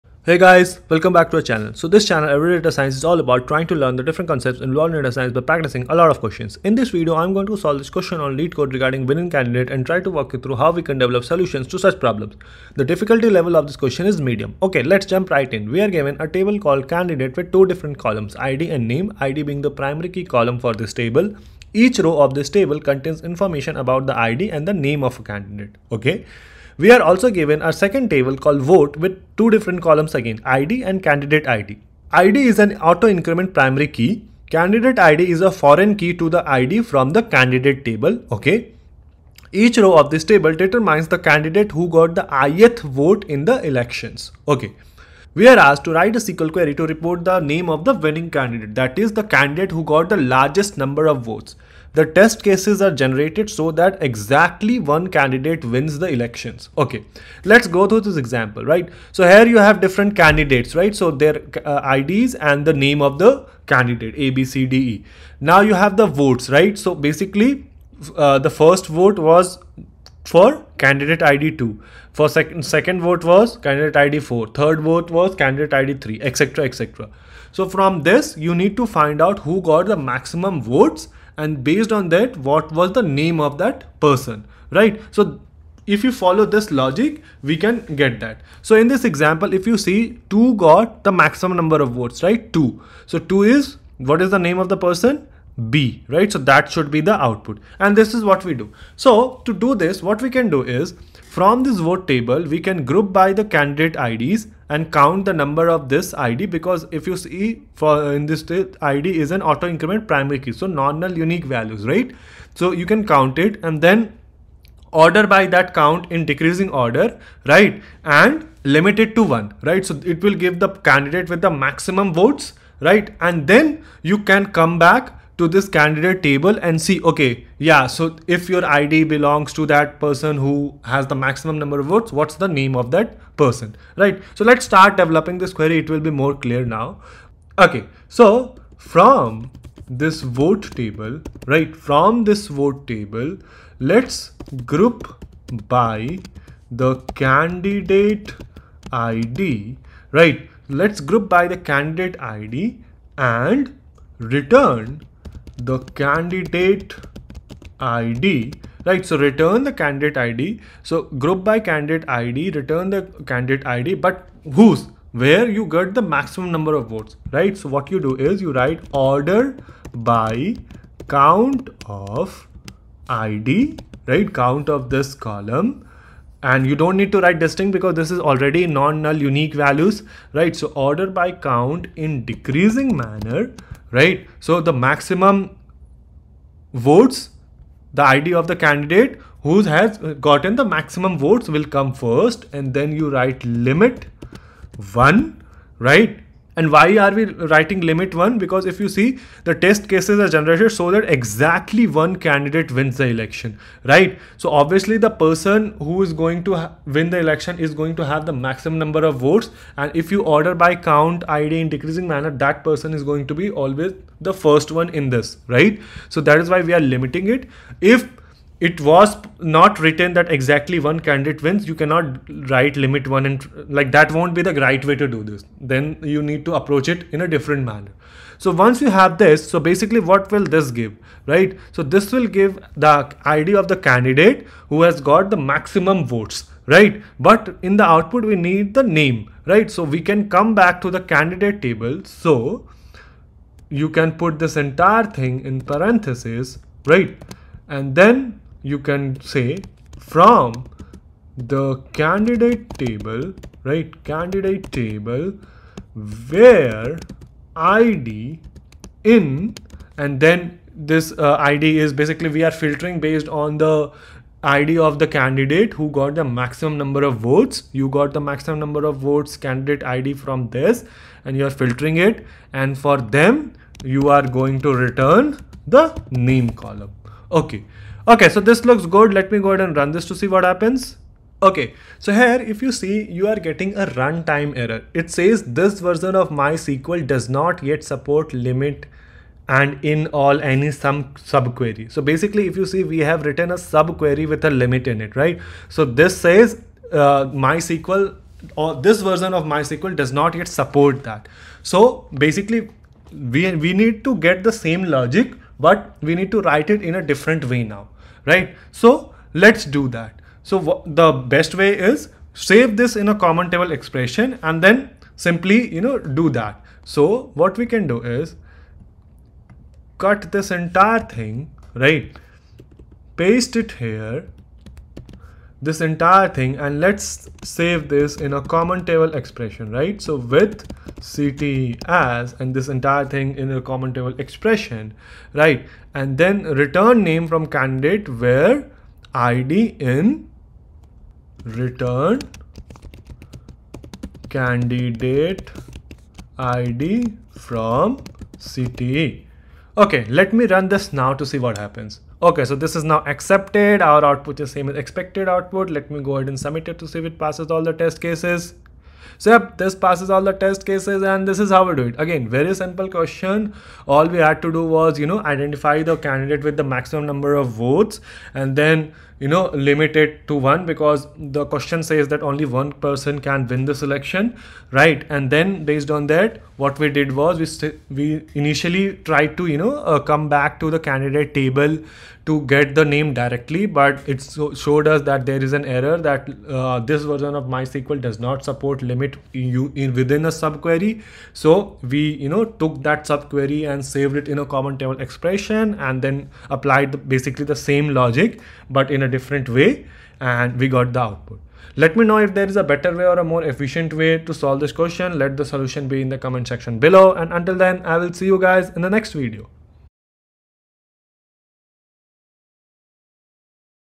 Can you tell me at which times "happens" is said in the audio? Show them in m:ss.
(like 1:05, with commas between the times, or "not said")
4:40, 5:51.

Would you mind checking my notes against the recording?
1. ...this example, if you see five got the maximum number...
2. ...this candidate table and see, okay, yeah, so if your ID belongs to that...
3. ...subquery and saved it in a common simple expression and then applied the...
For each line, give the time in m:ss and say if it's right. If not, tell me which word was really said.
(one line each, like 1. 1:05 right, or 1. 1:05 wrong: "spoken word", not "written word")
1. 1:28 wrong: "two", not "five"
2. 2:05 right
3. 6:33 wrong: "table", not "simple".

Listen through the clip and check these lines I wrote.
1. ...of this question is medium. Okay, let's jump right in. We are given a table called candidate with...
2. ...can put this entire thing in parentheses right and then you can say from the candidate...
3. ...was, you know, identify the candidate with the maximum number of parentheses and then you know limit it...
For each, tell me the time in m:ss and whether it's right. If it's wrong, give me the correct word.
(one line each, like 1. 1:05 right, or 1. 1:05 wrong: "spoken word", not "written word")
1. 0:13 right
2. 4:03 right
3. 6:04 wrong: "votes", not "parentheses".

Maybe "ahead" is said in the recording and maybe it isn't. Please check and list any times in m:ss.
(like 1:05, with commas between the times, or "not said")
4:39, 5:56.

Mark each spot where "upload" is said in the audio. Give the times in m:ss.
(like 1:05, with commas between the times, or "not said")
not said.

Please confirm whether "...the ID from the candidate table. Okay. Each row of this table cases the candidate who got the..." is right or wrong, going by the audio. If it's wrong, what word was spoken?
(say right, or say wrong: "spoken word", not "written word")
wrong: "determines", not "cases".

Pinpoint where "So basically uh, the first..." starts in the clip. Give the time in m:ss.
1:06.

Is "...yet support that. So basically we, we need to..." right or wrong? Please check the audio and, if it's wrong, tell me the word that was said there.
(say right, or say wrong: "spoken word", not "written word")
right.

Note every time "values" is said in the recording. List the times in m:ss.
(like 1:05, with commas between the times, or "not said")
1:51, 2:59.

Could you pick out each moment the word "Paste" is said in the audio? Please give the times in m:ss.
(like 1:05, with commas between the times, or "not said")
5:23.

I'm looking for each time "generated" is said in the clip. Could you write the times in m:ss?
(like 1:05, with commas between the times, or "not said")
0:52, 3:20.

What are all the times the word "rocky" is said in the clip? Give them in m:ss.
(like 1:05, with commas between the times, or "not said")
not said.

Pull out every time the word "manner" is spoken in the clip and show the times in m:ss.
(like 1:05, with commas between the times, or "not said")
3:02, 3:32, 3:47.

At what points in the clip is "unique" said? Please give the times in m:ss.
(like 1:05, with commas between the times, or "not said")
1:51, 2:59.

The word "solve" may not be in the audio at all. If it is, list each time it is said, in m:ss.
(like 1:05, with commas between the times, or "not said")
0:07, 6:44.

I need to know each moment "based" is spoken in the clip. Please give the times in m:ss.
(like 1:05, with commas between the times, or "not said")
1:21, 4:22, 6:15.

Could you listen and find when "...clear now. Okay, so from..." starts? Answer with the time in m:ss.
2:16.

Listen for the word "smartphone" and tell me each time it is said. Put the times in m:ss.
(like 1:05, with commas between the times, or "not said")
not said.